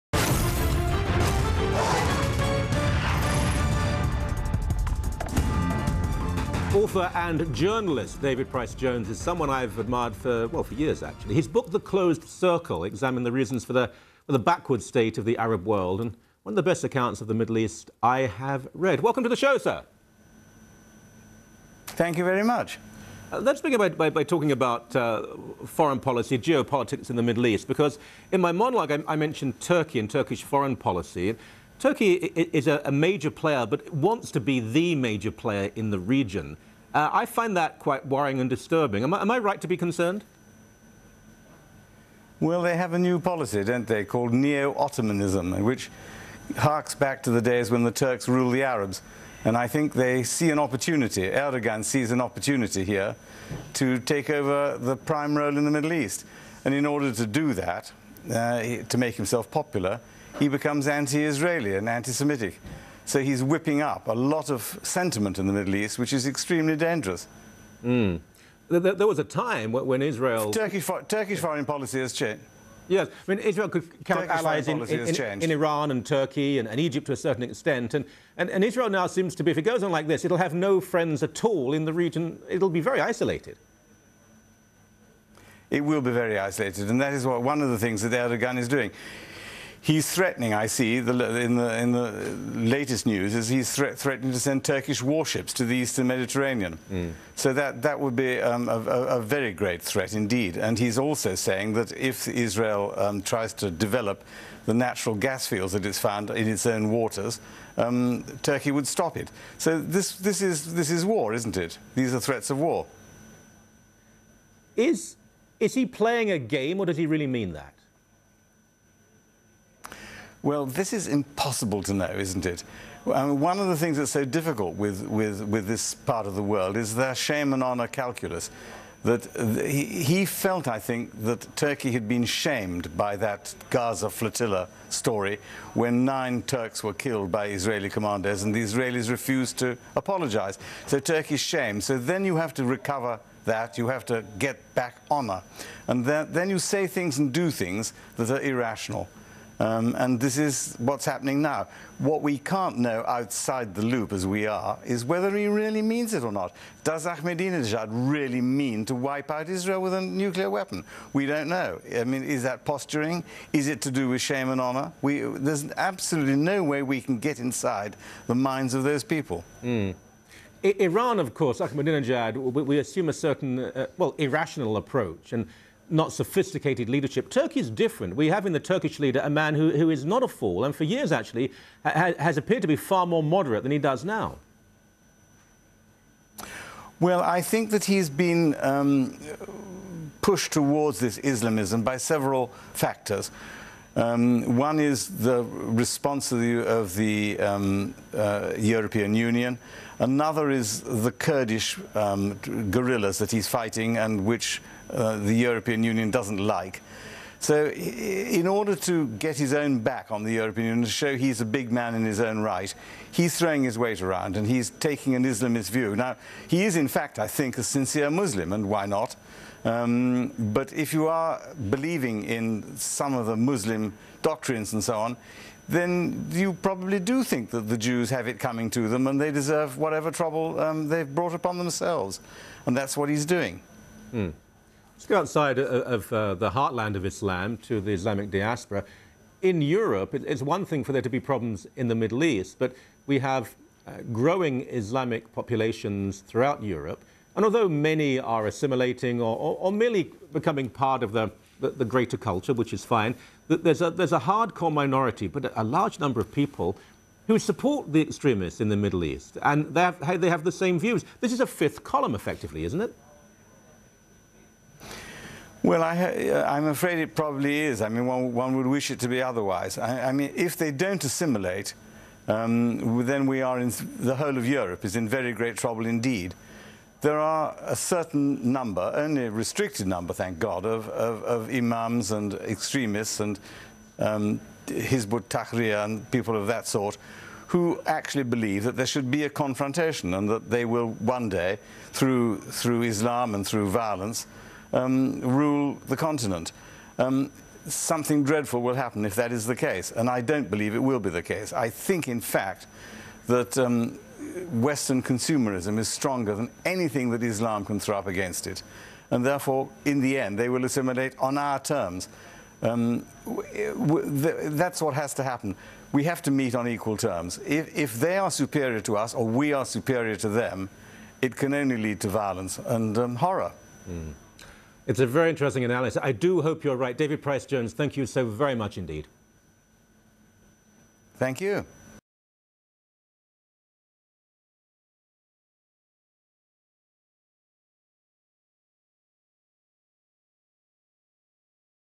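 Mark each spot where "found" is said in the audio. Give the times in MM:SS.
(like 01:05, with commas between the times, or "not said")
01:45.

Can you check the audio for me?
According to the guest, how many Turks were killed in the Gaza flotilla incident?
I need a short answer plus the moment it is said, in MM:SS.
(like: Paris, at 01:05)
9, at 02:16.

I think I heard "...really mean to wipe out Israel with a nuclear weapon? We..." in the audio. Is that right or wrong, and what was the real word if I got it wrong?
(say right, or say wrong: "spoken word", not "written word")
right.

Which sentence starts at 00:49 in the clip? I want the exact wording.
And I think they see an opportunity, Erdogan sees an opportunity here to take over the prime role in the Middle East.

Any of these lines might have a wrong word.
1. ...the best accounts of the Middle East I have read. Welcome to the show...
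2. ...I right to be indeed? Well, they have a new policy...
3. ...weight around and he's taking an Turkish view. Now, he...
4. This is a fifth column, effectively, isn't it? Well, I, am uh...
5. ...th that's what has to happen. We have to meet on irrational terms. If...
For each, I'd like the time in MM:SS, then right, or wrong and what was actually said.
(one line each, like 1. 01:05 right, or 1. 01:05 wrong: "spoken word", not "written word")
1. 00:16 right
2. 00:39 wrong: "concerned", not "indeed"
3. 03:33 wrong: "Islamist", not "Turkish"
4. 04:21 right
5. 05:14 wrong: "equal", not "irrational".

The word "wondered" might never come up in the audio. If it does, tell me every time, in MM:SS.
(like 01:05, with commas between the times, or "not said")
not said.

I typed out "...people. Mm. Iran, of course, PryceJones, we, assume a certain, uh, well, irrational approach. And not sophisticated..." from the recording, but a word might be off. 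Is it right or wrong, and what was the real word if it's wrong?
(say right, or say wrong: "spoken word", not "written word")
wrong: "Ahmadinejad", not "PryceJones".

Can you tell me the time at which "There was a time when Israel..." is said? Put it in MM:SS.
01:08.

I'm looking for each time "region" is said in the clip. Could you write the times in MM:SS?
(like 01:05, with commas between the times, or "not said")
00:35, 01:21.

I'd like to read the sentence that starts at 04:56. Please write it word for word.
Um, something dreadful will happen if that is the case, and I don't believe it will be the case.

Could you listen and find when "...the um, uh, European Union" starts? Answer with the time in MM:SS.
03:16.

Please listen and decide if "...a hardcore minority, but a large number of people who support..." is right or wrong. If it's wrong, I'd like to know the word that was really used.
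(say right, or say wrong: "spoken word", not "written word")
right.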